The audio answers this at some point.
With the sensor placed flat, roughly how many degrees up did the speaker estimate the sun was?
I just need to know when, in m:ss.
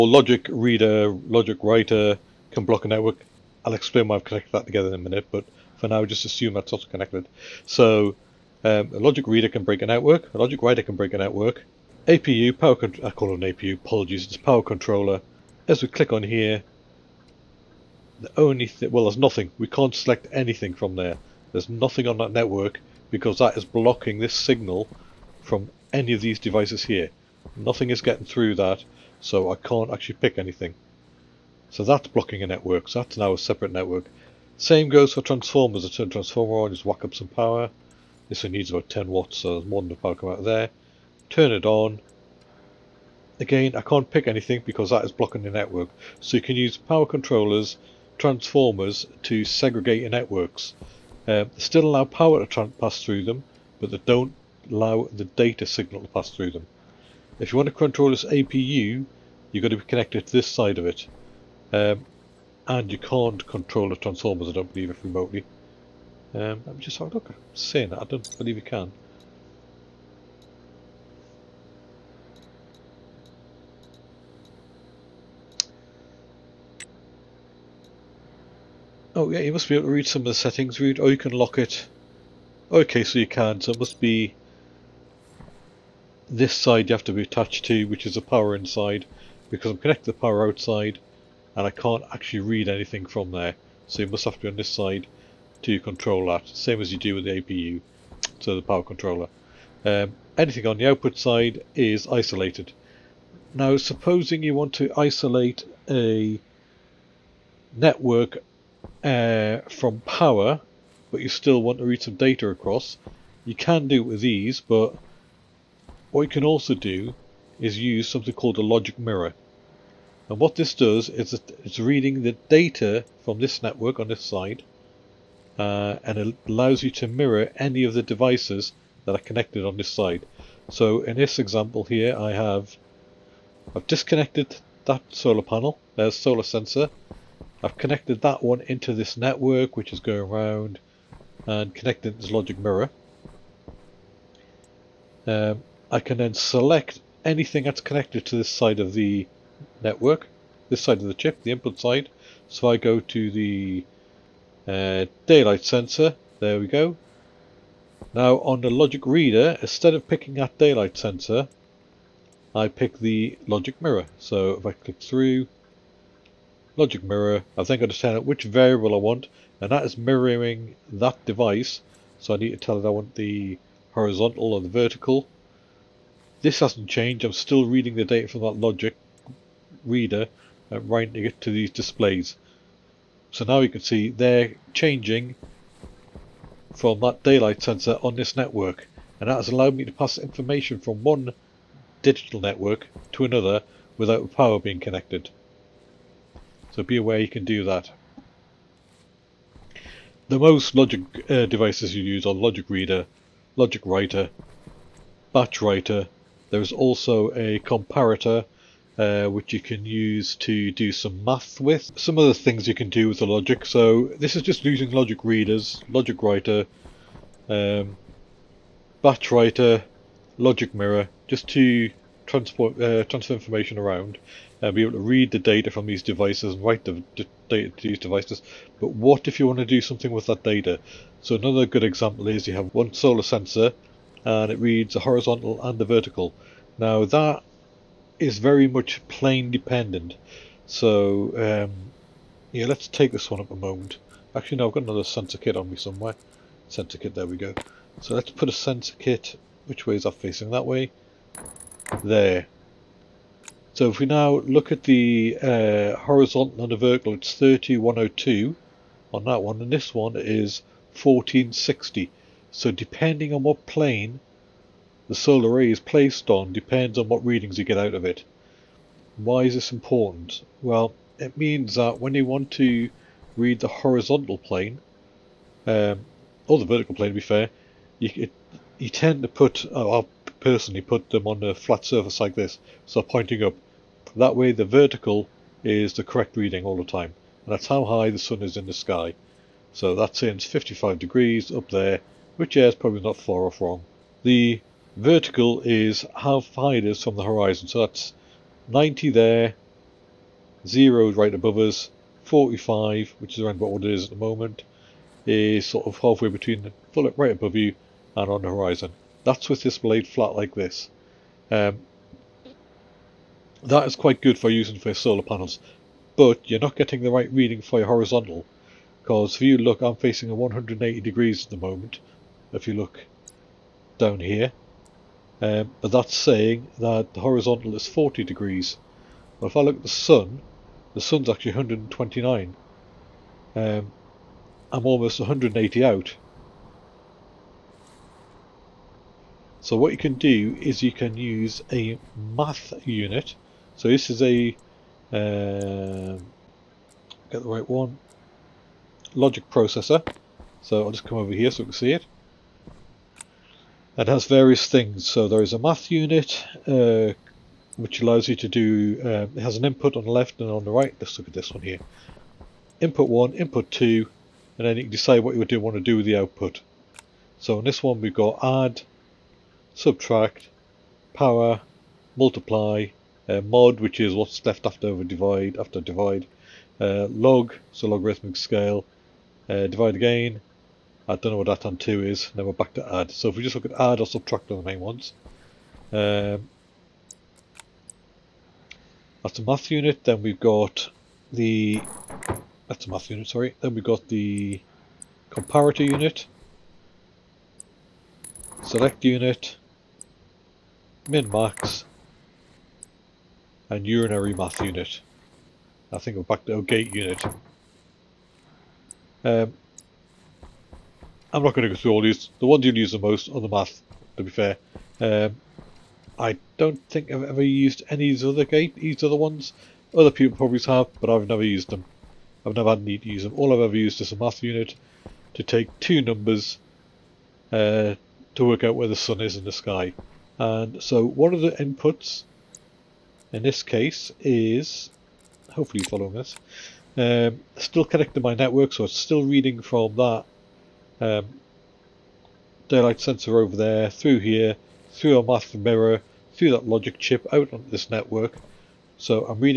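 4:50.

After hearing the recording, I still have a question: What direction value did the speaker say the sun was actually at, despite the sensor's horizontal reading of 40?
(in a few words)
129.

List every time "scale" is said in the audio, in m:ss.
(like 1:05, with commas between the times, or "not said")
6:18.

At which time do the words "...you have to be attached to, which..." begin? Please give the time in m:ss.
1:26.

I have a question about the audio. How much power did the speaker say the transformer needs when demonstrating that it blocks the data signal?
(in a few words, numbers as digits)
10 watts.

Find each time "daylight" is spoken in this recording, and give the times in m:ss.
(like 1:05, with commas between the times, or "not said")
2:35, 2:40, 3:07, 7:22.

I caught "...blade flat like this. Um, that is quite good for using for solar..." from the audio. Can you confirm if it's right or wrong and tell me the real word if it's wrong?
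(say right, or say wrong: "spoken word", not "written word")
right.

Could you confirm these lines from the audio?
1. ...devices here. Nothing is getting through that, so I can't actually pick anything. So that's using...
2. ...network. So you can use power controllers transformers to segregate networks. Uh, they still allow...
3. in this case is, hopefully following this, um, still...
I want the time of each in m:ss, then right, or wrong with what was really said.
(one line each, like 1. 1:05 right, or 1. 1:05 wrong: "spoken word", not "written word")
1. 0:26 wrong: "blocking", not "using"
2. 0:45 right
3. 7:13 right.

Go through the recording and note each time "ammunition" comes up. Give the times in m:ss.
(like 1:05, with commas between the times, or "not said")
not said.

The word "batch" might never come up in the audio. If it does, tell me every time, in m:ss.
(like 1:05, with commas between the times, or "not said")
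3:25, 3:39.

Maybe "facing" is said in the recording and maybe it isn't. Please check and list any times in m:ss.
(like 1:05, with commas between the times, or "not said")
4:10, 5:19.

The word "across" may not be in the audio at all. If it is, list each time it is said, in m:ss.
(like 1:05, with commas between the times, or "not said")
1:52.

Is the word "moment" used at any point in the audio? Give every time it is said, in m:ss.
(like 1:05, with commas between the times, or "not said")
4:03, 5:04, 5:21.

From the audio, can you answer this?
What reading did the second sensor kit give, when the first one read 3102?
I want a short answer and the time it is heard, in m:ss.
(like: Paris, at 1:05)
1460, at 4:20.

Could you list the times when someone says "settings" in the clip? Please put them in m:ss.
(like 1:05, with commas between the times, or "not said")
1:20.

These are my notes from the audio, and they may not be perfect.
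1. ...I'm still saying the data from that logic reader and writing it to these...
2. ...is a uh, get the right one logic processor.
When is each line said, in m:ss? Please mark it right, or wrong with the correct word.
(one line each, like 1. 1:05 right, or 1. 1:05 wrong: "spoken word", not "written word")
1. 2:57 wrong: "reading", not "saying"
2. 5:44 right.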